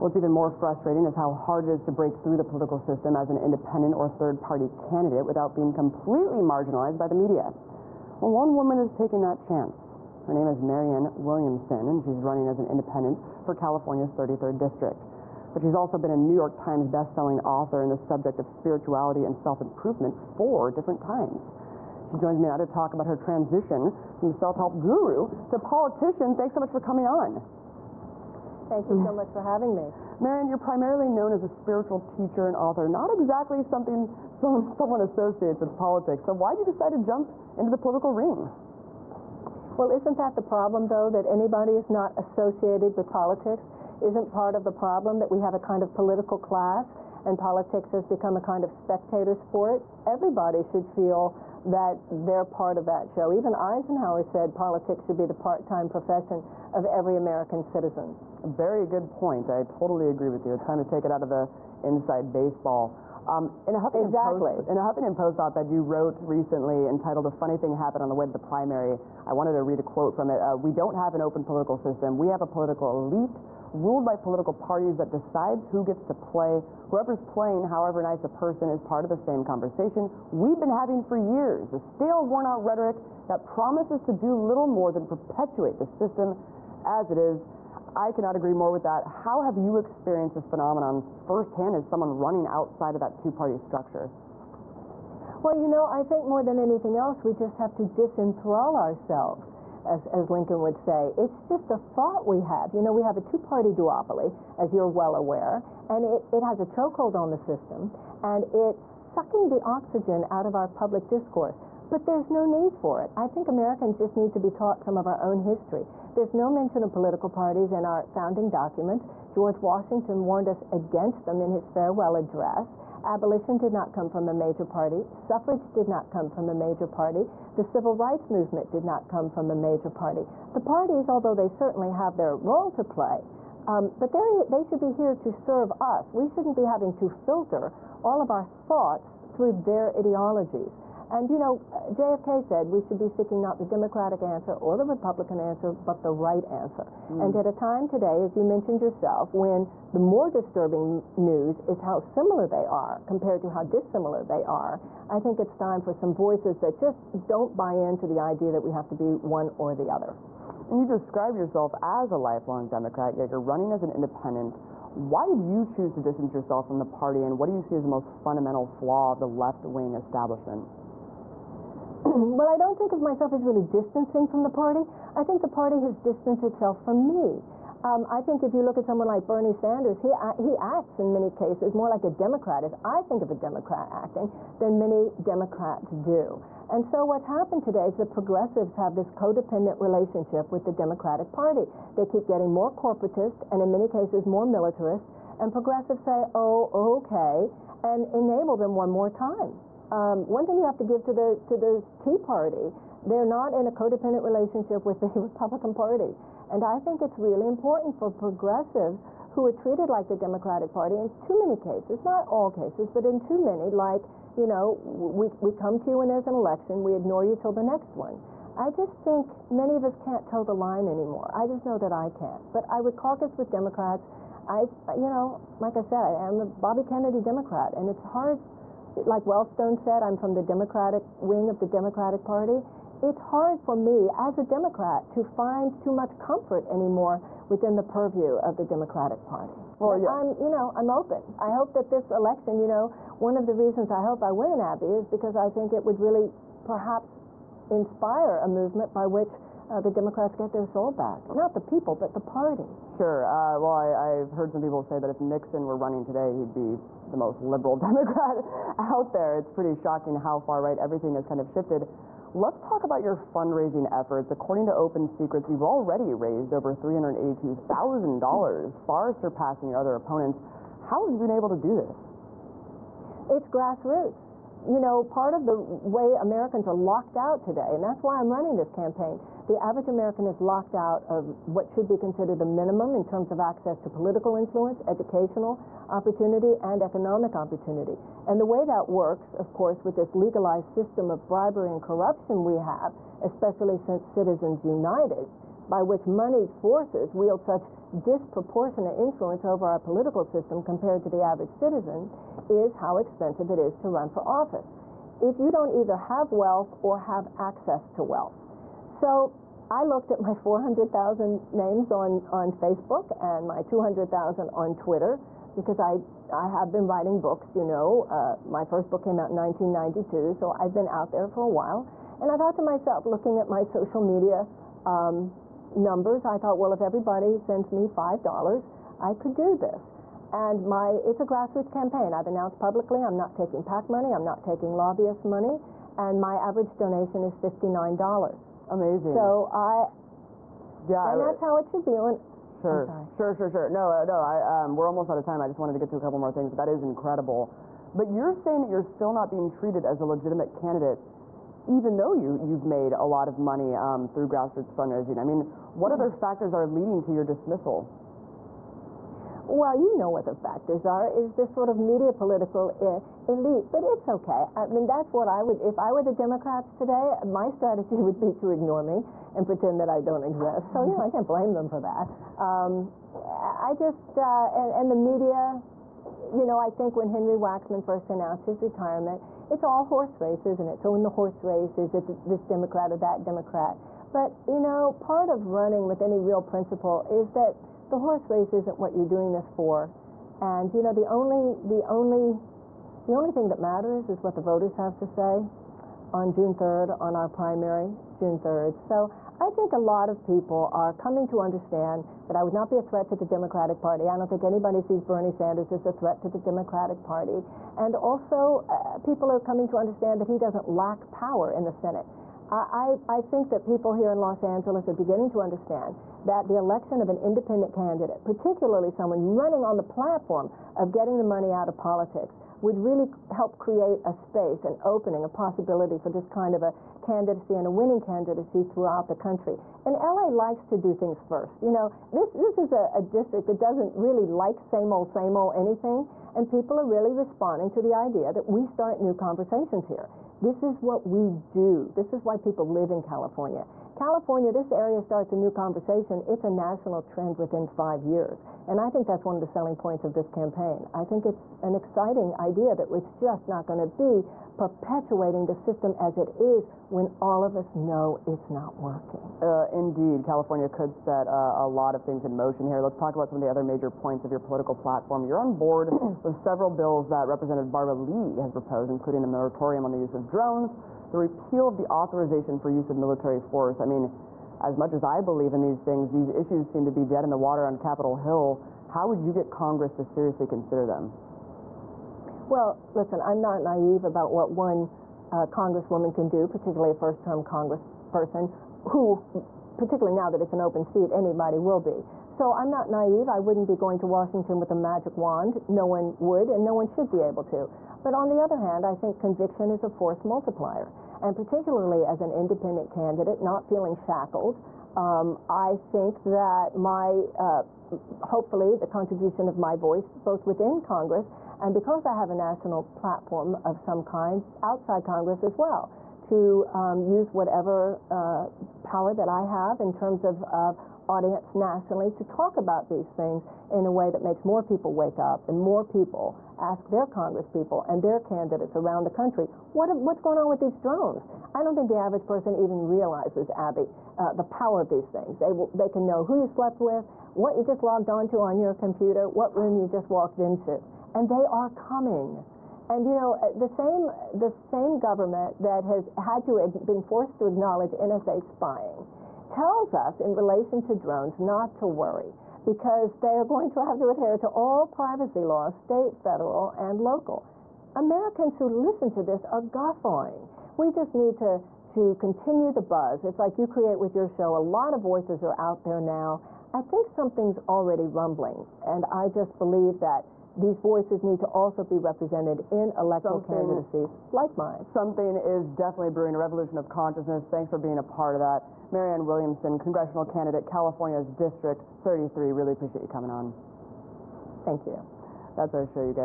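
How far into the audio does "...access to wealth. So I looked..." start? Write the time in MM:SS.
05:07.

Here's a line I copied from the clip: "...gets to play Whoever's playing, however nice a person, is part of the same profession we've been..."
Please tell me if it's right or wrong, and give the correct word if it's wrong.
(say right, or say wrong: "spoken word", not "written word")
wrong: "conversation", not "profession".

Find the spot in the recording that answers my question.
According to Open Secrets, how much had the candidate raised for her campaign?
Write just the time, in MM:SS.
04:26.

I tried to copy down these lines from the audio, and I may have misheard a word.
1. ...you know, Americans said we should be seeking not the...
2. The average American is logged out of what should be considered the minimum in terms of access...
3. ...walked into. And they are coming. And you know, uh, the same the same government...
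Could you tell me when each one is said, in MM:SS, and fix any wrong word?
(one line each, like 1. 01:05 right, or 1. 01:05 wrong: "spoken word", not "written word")
1. 02:21 wrong: "JFK", not "Americans"
2. 04:39 wrong: "locked", not "logged"
3. 09:00 right.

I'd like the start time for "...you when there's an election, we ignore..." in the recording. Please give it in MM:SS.
03:35.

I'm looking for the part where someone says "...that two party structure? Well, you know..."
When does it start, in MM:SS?
01:32.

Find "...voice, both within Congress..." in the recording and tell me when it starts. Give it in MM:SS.
08:29.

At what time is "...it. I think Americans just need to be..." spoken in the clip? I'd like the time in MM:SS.
01:53.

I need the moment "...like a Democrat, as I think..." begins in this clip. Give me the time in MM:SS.
03:01.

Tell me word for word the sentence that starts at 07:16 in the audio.
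And people are really responding to the idea that we start new conversations here.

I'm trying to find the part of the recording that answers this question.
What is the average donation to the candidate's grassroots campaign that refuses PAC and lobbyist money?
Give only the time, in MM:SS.
05:37.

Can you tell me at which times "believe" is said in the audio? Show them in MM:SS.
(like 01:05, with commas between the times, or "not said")
07:55, 09:29.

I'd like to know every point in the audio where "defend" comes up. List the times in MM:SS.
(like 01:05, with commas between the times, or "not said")
not said.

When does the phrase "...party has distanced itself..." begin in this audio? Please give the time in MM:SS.
02:55.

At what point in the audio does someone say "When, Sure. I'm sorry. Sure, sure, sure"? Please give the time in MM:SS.
05:41.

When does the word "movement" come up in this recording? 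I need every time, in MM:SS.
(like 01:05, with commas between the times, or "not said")
02:08, 04:08.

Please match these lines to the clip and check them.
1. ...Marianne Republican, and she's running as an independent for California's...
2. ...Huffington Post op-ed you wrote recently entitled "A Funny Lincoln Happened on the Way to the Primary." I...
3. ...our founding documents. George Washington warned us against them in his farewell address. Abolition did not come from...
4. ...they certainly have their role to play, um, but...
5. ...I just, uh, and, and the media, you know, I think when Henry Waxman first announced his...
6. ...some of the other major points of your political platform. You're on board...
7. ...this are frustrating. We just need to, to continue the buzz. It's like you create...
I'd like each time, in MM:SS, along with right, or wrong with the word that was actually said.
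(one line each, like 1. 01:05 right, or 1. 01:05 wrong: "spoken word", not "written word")
1. 00:10 wrong: "Williamson", not "Republican"
2. 01:04 wrong: "Thing", not "Lincoln"
3. 01:57 right
4. 02:11 right
5. 06:13 right
6. 07:43 right
7. 09:19 wrong: "guffawing", not "frustrating".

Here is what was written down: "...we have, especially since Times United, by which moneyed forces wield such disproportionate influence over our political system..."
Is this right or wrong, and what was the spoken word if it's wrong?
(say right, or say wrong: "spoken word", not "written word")
wrong: "Citizens", not "Times".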